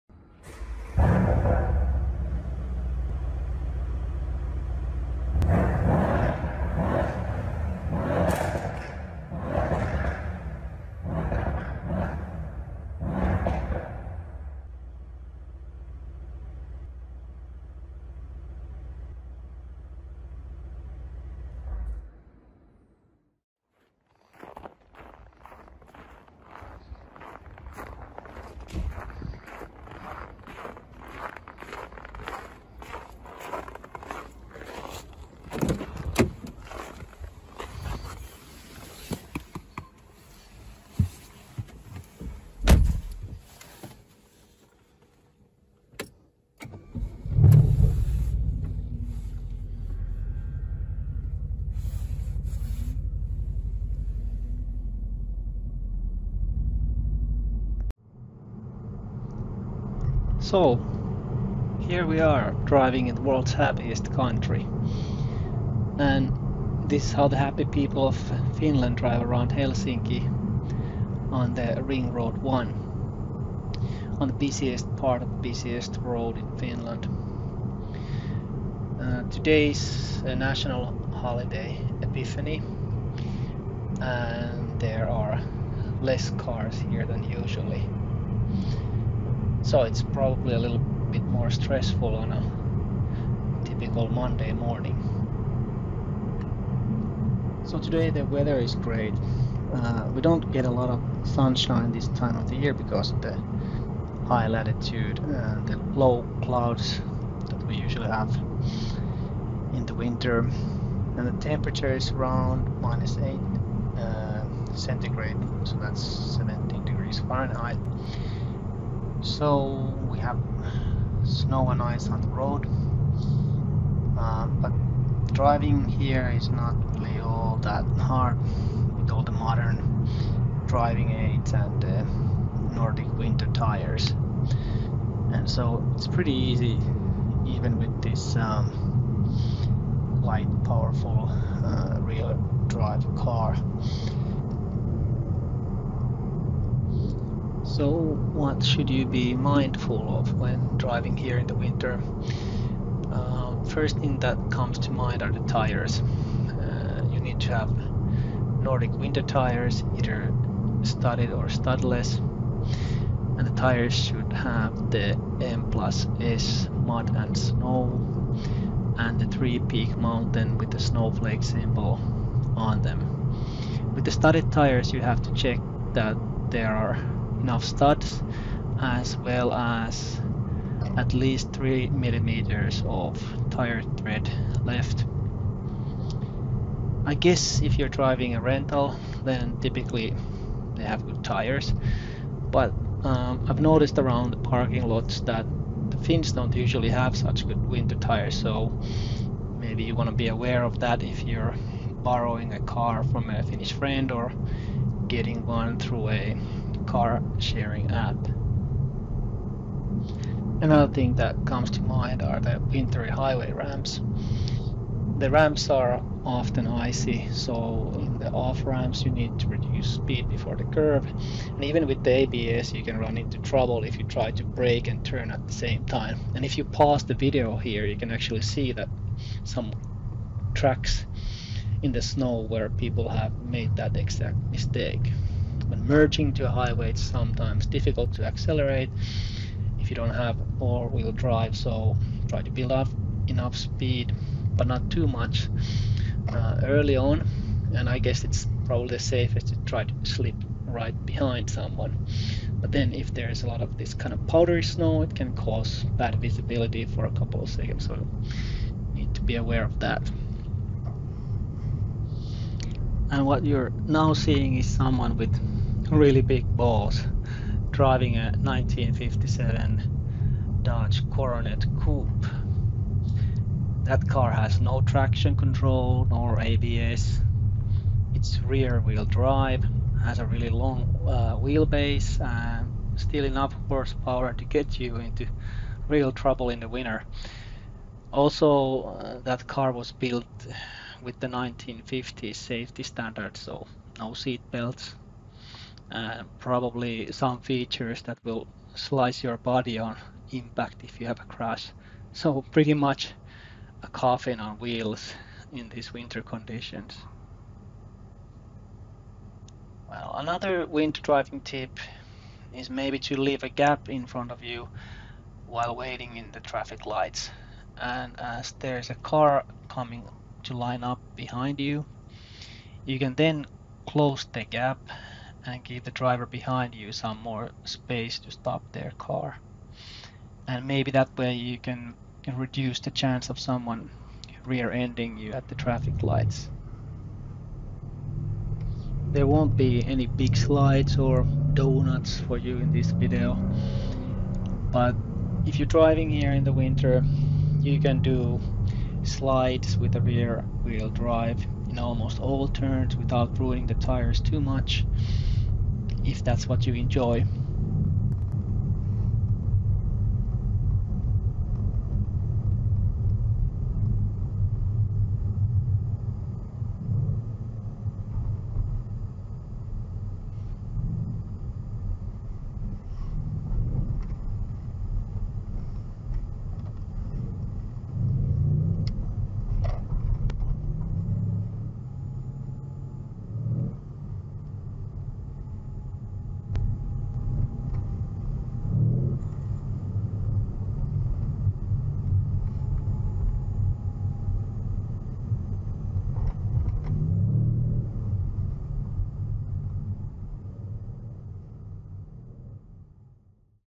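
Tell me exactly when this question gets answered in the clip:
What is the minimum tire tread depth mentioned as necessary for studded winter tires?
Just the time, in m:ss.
3:01.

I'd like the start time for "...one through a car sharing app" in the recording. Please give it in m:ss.
3:25.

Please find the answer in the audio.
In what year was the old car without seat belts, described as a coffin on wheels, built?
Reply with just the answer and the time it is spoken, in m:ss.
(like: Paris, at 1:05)
1957, at 4:28.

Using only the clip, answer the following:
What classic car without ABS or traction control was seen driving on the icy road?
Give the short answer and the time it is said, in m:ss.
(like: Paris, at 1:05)
Dodge Coronet Coupe, at 4:30.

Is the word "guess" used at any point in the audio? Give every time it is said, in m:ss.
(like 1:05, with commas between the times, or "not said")
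3:07, 4:07.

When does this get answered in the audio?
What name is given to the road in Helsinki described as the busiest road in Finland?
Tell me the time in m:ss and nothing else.
1:11.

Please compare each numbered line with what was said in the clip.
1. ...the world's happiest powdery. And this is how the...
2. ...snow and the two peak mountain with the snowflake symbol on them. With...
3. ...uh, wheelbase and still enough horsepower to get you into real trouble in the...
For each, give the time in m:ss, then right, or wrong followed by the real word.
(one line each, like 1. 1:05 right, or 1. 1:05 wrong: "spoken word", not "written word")
1. 1:03 wrong: "country", not "powdery"
2. 2:47 wrong: "three", not "two"
3. 4:41 right.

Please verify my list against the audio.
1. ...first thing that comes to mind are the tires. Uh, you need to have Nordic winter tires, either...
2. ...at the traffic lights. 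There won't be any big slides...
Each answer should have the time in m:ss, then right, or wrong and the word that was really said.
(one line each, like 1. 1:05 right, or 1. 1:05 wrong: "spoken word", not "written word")
1. 2:33 right
2. 5:35 right.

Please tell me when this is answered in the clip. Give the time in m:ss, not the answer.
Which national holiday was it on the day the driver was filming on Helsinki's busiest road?
1:22.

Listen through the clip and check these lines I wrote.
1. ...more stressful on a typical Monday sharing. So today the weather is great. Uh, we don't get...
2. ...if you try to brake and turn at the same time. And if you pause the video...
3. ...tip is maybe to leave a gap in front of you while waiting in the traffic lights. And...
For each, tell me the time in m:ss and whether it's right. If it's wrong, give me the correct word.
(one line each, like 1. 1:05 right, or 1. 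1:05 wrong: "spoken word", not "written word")
1. 1:31 wrong: "morning", not "sharing"
2. 3:43 right
3. 5:11 right.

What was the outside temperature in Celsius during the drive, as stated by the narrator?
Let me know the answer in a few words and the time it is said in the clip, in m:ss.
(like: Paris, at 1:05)
-8, at 1:52.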